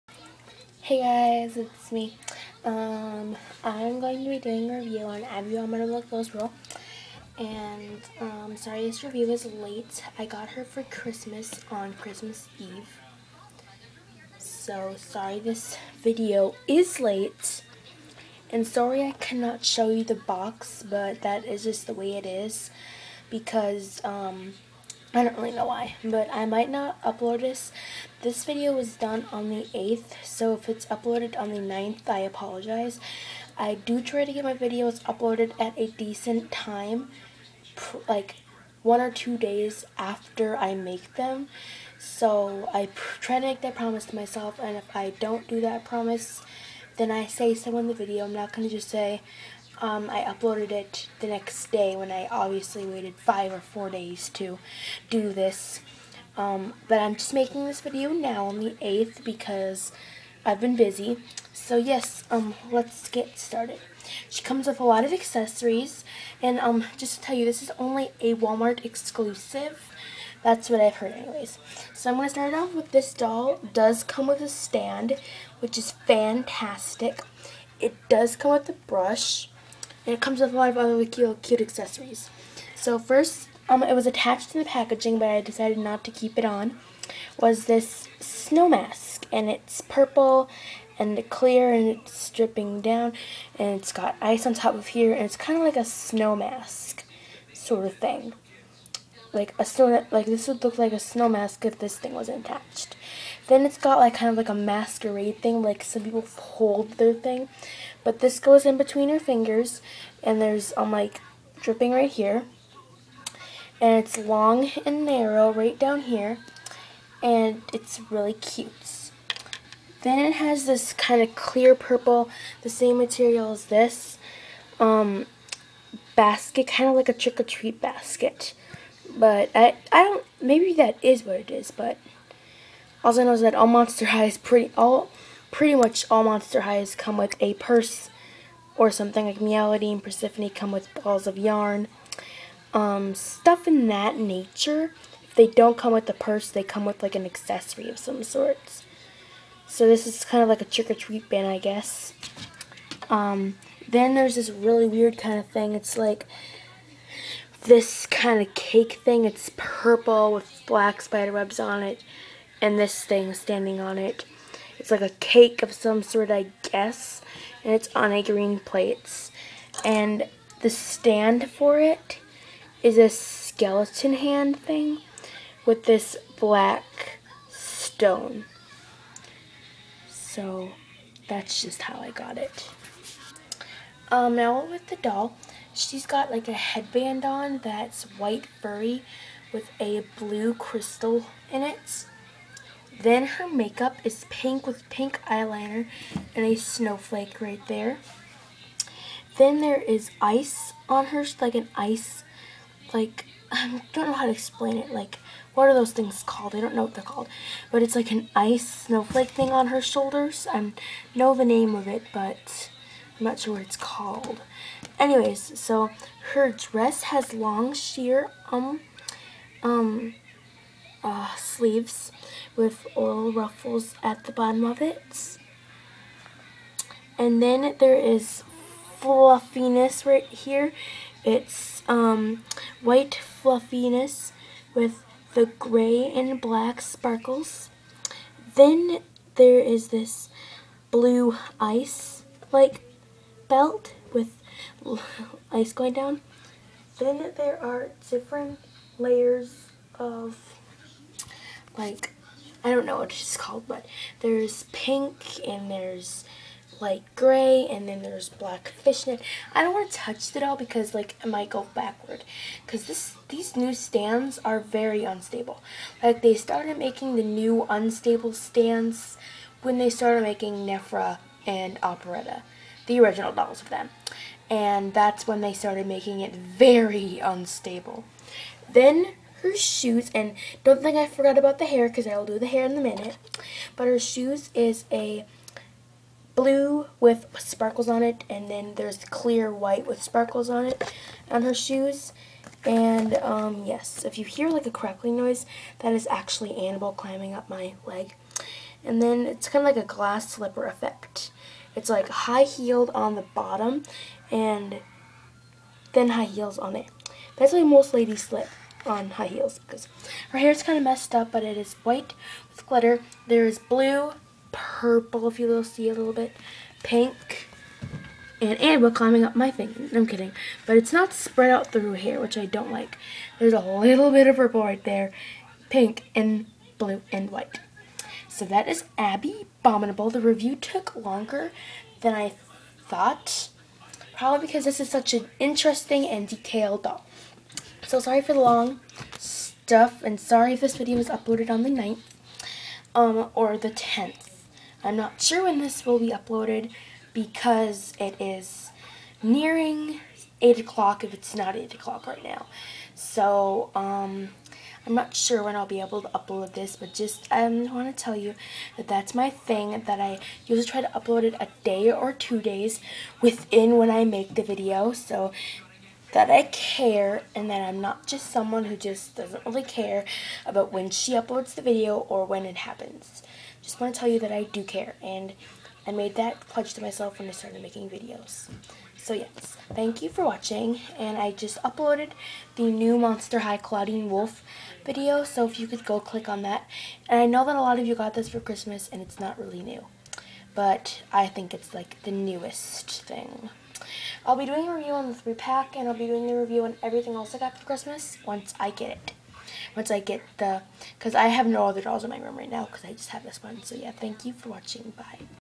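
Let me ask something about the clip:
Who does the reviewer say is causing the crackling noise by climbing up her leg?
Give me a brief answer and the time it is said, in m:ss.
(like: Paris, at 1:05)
Annabelle, at 4:56.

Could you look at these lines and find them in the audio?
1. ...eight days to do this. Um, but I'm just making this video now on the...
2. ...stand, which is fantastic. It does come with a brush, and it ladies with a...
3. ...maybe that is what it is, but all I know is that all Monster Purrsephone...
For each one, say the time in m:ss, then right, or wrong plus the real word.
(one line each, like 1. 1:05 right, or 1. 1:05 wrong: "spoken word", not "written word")
1. 0:53 wrong: "four", not "eight"
2. 1:14 wrong: "comes", not "ladies"
3. 2:10 wrong: "Highs", not "Purrsephone".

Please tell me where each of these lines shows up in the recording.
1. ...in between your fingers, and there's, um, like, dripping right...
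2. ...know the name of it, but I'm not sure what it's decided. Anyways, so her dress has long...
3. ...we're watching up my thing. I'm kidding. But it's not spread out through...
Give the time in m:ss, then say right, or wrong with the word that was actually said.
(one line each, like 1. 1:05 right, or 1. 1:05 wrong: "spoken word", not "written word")
1. 1:48 right
2. 3:31 wrong: "called", not "decided"
3. 5:18 wrong: "climbing", not "watching".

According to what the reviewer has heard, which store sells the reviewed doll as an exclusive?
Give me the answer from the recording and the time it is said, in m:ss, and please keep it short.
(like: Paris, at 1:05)
Walmart, at 1:08.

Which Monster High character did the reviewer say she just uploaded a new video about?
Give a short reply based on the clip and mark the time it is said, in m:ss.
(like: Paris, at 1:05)
Clawdeen Wolf, at 6:23.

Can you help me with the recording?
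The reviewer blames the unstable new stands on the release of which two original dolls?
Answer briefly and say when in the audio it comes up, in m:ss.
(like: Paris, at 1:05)
Nefera and Operetta, at 4:30.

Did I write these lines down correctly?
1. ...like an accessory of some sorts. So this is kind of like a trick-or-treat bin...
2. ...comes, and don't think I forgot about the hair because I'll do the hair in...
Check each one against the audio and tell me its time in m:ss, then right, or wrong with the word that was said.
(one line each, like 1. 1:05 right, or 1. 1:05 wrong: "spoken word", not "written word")
1. 2:27 right
2. 4:39 wrong: "shoes", not "comes".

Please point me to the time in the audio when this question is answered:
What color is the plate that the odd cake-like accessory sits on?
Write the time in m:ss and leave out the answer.
2:48.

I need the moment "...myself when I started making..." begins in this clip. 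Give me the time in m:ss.
6:16.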